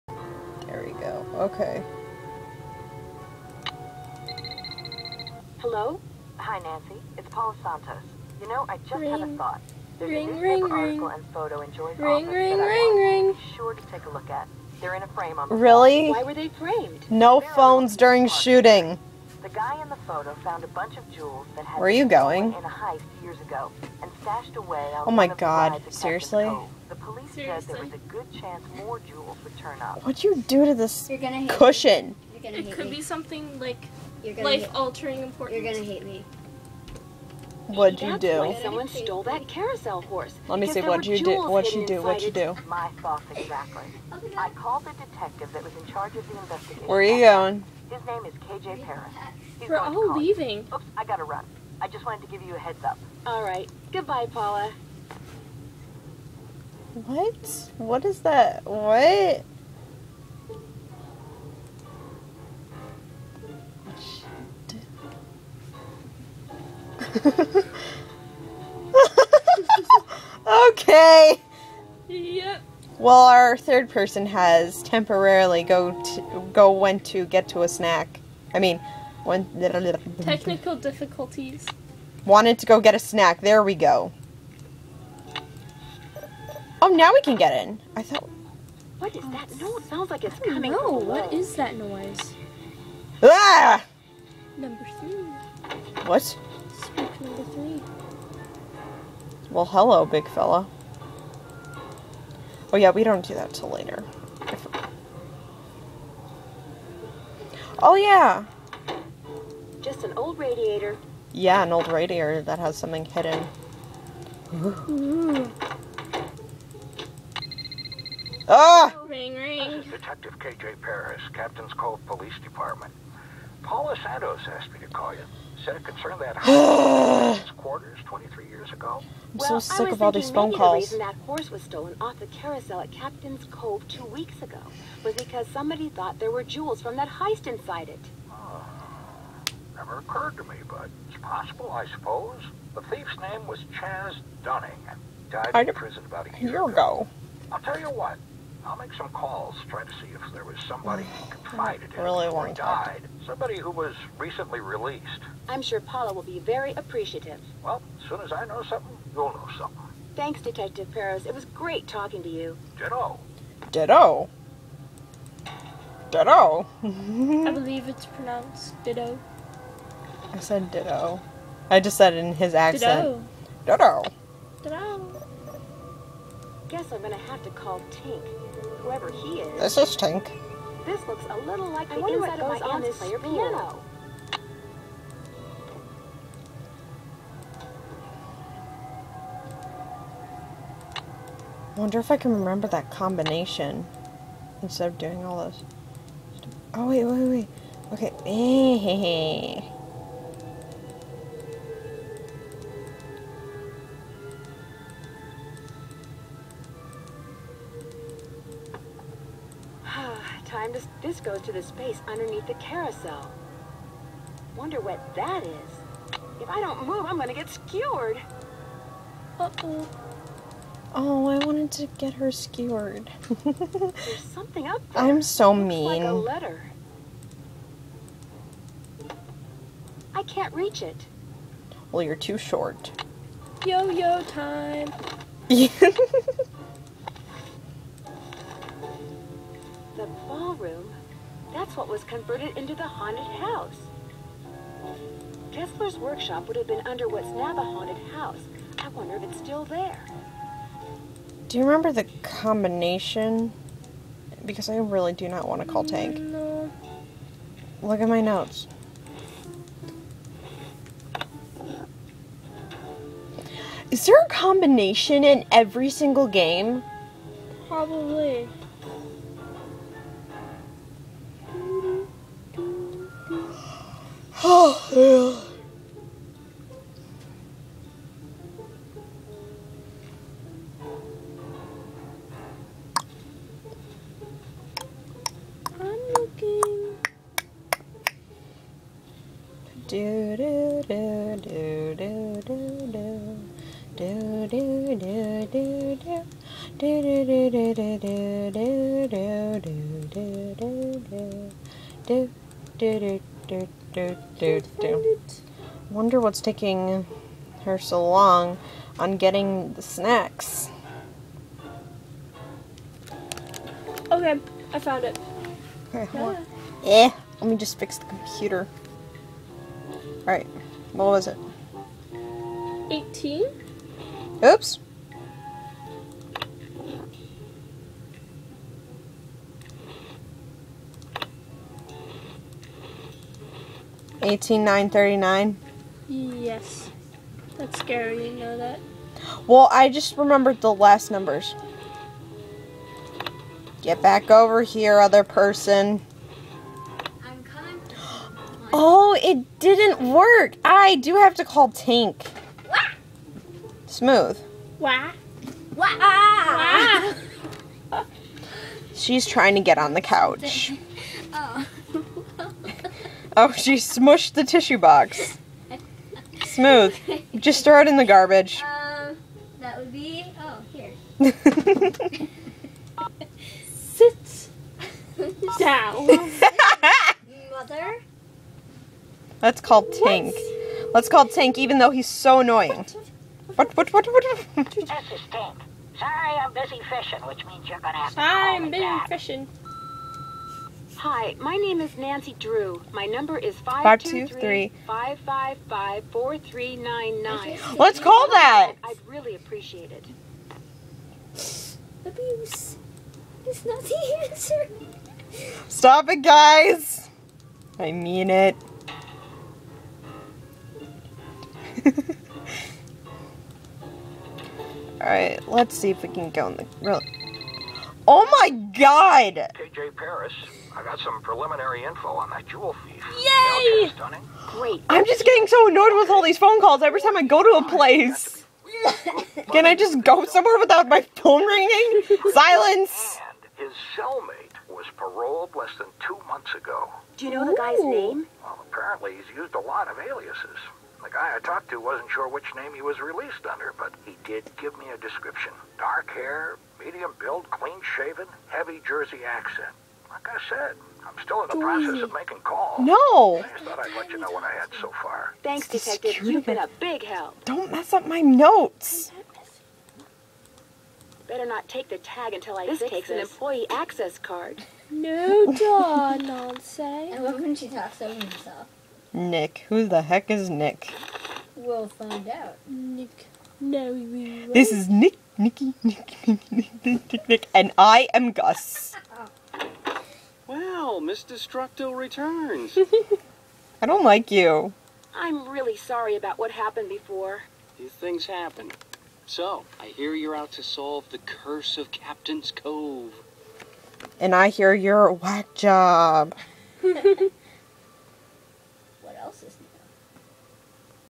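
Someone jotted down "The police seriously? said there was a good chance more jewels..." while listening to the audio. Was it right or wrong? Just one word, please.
right.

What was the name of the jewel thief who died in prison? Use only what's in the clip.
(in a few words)
Chaz Dunning.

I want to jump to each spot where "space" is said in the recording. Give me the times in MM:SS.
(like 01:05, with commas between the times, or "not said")
03:31.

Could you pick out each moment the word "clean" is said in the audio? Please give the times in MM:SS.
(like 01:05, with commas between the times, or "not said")
07:27.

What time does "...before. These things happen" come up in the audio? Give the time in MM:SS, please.
08:06.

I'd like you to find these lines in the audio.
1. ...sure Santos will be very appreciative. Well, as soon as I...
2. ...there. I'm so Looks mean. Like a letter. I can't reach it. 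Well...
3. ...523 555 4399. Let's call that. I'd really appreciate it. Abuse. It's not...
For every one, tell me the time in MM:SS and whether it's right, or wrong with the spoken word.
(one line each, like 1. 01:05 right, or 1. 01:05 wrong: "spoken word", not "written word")
1. 02:35 wrong: "Paula", not "Santos"
2. 03:44 right
3. 06:33 right.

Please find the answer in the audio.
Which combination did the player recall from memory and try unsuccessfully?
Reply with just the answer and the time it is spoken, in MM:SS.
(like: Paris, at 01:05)
18 9 39, at 05:34.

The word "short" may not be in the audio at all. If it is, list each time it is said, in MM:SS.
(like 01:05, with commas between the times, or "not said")
03:52.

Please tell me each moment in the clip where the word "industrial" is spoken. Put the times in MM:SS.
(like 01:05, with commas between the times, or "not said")
not said.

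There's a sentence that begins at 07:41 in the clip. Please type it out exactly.
Better not take the tag until I this fix takes this.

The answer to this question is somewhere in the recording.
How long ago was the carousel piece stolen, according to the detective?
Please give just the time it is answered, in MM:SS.
02:13.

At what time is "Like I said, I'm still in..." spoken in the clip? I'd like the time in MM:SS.
07:30.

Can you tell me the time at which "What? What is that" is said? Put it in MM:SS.
00:56.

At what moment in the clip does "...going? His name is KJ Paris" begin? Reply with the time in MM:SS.
00:47.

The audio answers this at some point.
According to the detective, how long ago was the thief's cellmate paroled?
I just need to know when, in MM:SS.
07:15.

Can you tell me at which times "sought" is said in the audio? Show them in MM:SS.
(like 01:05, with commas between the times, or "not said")
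not said.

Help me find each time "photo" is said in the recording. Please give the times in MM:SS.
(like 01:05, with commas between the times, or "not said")
00:11, 00:19.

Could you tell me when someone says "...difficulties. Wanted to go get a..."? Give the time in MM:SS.
01:20.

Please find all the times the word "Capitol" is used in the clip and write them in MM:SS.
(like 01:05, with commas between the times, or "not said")
not said.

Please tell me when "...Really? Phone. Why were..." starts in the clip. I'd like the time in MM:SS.
00:15.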